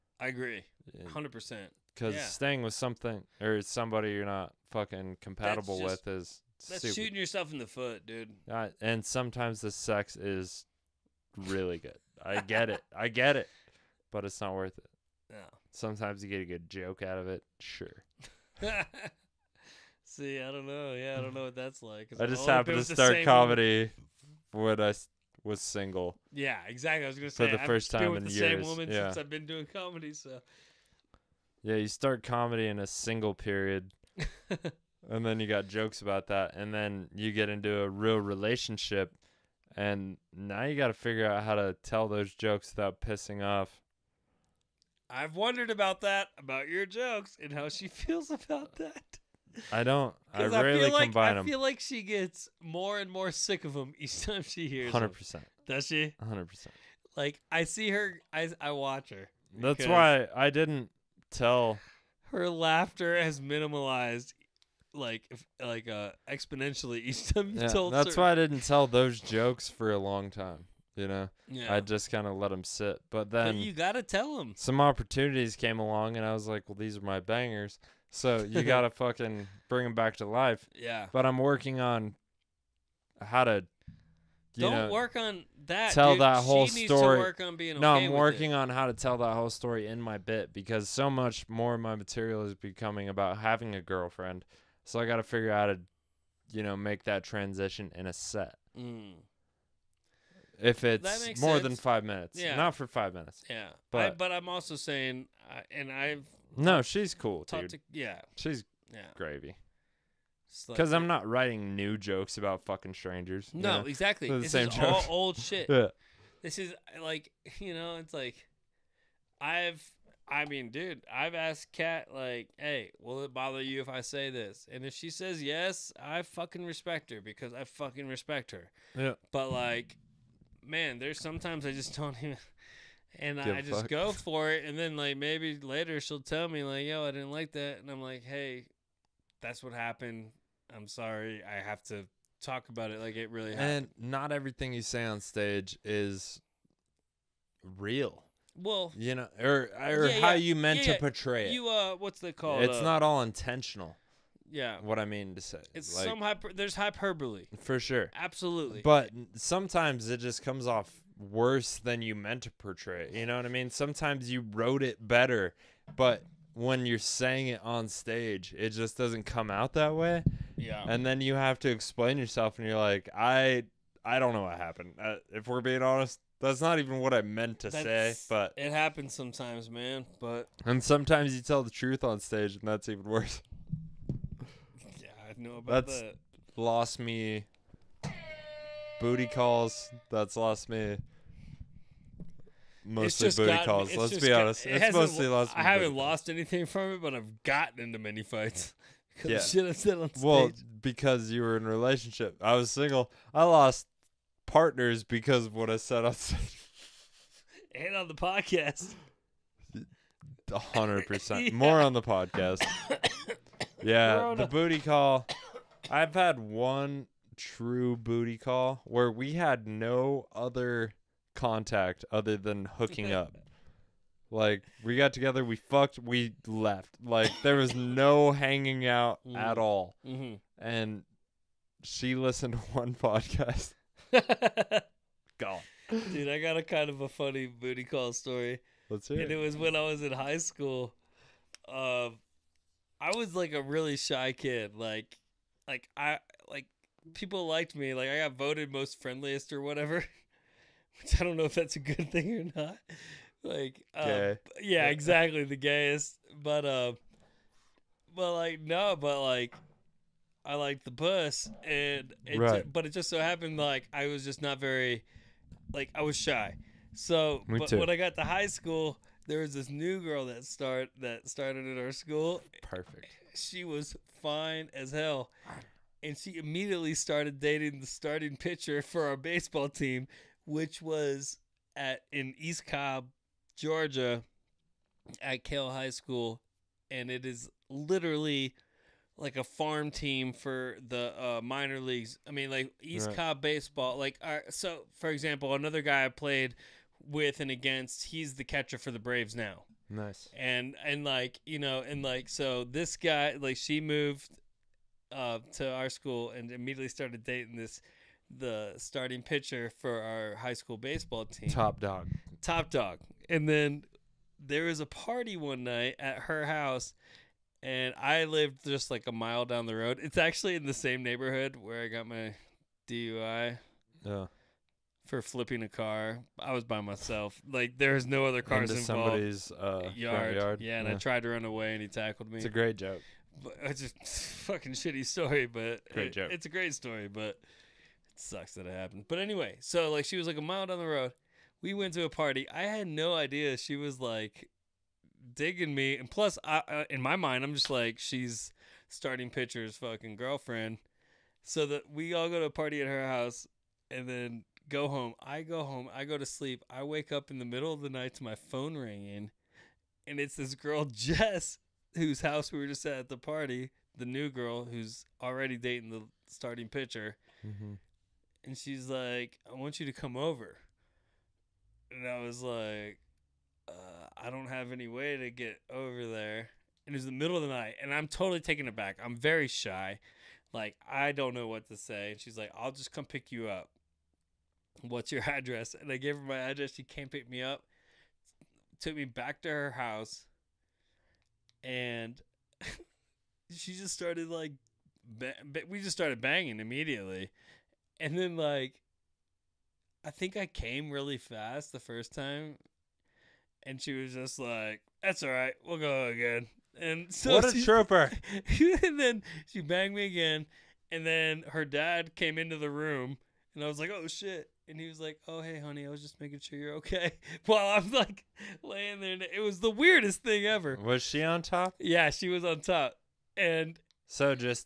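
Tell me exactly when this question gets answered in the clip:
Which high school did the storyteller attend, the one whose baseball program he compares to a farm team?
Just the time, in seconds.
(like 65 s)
285 s.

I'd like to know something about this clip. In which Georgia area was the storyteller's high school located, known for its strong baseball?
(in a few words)
East Cobb.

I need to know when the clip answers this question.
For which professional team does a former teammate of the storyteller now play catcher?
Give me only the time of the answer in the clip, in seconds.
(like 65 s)
298 s.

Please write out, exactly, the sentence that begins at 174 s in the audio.
Uh, if we're being honest, that's not even what I meant to that's, say.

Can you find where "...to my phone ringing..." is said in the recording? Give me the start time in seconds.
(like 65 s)
358 s.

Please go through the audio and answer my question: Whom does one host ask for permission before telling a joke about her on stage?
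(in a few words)
Kat.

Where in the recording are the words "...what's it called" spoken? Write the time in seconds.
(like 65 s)
151 s.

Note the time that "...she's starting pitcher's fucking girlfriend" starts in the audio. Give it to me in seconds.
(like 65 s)
347 s.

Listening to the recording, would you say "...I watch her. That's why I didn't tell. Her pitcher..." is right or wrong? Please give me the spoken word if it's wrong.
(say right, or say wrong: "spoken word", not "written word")
wrong: "laughter", not "pitcher".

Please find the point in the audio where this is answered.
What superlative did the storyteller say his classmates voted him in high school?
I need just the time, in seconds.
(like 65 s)
248 s.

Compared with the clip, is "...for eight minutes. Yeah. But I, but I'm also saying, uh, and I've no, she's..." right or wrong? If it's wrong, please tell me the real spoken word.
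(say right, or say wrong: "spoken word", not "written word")
wrong: "five", not "eight".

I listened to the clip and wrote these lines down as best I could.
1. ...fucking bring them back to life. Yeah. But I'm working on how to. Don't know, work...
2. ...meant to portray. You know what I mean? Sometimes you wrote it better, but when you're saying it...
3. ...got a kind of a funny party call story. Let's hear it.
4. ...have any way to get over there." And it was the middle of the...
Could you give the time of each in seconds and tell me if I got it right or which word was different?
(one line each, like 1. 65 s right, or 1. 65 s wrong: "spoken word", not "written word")
1. 78 s right
2. 162 s right
3. 236 s wrong: "booty", not "party"
4. 374 s right.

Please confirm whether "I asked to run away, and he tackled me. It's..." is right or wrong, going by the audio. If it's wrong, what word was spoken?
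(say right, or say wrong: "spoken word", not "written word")
wrong: "tried", not "asked".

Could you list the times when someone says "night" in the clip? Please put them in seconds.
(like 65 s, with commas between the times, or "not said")
315 s, 357 s, 377 s.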